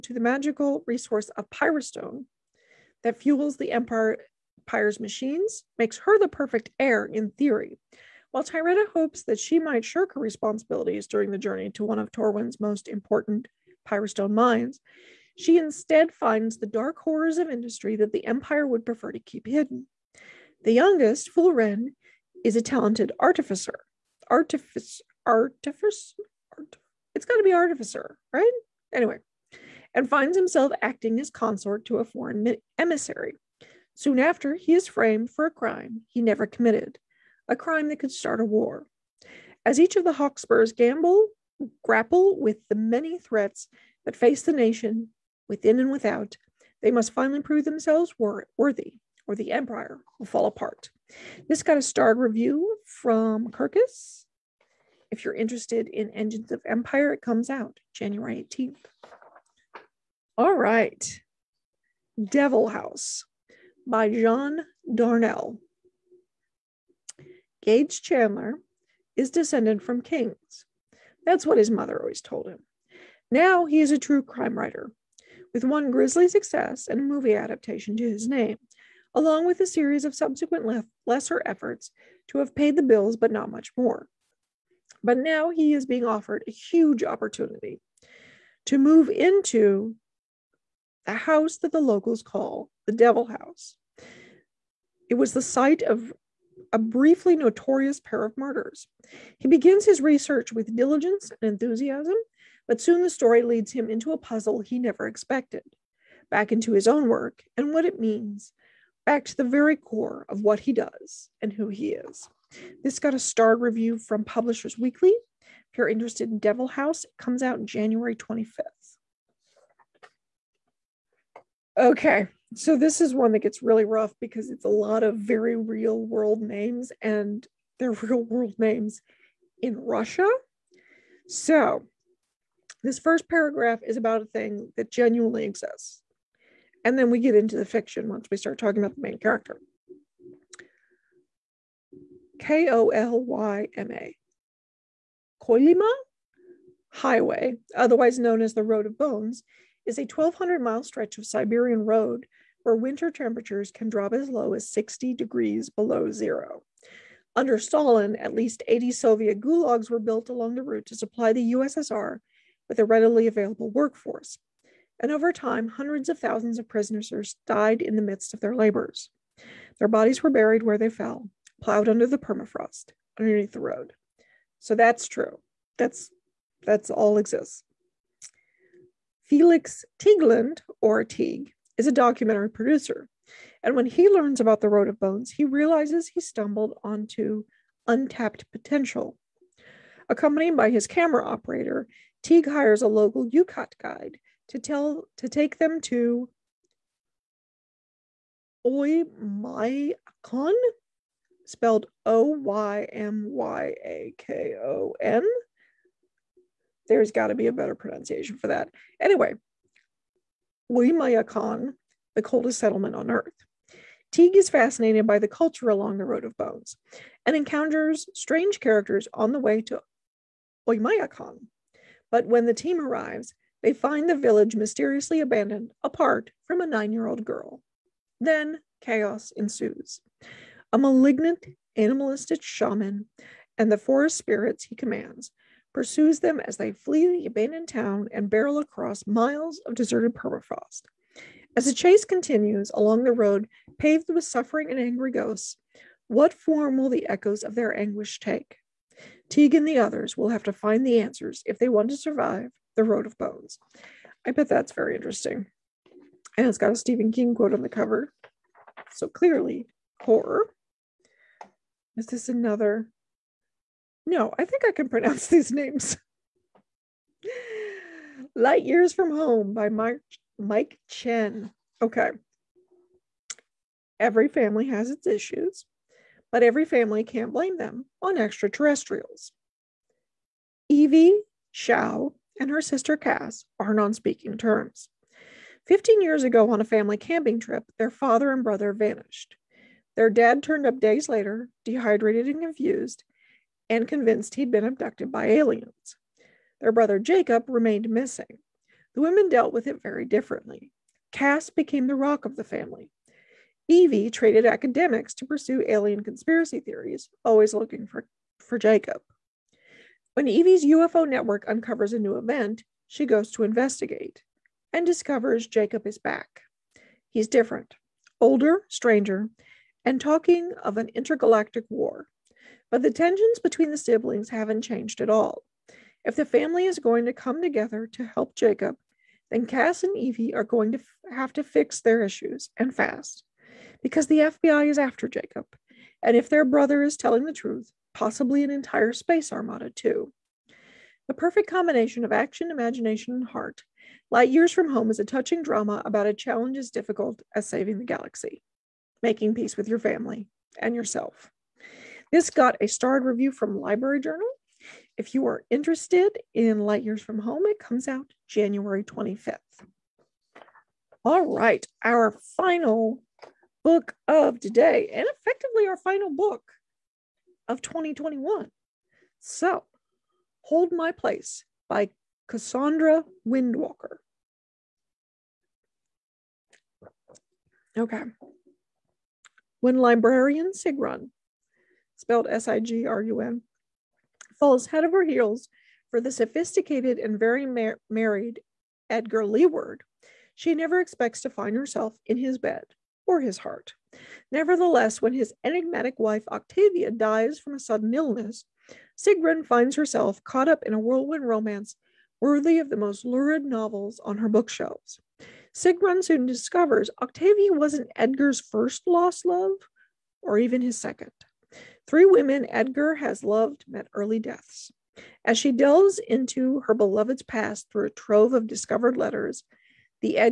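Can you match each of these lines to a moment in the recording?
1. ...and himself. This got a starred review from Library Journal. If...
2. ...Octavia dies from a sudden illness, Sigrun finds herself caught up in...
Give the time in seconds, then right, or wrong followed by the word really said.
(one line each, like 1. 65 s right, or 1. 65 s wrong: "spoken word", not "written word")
1. 350 s wrong: "yourself", not "himself"
2. 396 s right.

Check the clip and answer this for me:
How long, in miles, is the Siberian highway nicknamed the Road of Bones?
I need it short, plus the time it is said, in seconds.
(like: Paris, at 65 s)
1,200 miles, at 150 s.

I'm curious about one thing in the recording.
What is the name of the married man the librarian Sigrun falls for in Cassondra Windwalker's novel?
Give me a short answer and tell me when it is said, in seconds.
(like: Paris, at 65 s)
Edgar Leeward, at 388 s.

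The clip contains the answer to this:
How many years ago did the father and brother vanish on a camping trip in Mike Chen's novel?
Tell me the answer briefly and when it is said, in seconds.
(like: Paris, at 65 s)
15, at 285 s.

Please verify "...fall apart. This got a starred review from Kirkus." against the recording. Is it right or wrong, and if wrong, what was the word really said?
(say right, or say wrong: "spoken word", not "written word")
right.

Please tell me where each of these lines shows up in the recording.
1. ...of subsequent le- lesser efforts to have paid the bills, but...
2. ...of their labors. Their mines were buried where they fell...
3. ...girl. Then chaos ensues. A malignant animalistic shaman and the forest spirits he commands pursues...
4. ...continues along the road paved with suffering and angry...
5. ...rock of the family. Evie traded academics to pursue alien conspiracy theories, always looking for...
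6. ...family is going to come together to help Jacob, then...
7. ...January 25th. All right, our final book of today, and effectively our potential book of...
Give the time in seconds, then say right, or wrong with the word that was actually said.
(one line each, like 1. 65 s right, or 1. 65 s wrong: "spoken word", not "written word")
1. 80 s right
2. 168 s wrong: "bodies", not "mines"
3. 227 s right
4. 242 s right
5. 301 s right
6. 326 s right
7. 358 s wrong: "final", not "potential".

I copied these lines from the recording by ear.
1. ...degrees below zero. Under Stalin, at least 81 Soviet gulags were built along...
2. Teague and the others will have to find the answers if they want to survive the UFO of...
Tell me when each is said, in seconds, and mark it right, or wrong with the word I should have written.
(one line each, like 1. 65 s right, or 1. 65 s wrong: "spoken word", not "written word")
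1. 155 s wrong: "80", not "81"
2. 249 s wrong: "Road", not "UFO".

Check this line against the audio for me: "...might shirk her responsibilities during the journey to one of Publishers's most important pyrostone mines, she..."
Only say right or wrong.
wrong.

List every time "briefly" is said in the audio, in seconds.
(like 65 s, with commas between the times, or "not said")
96 s.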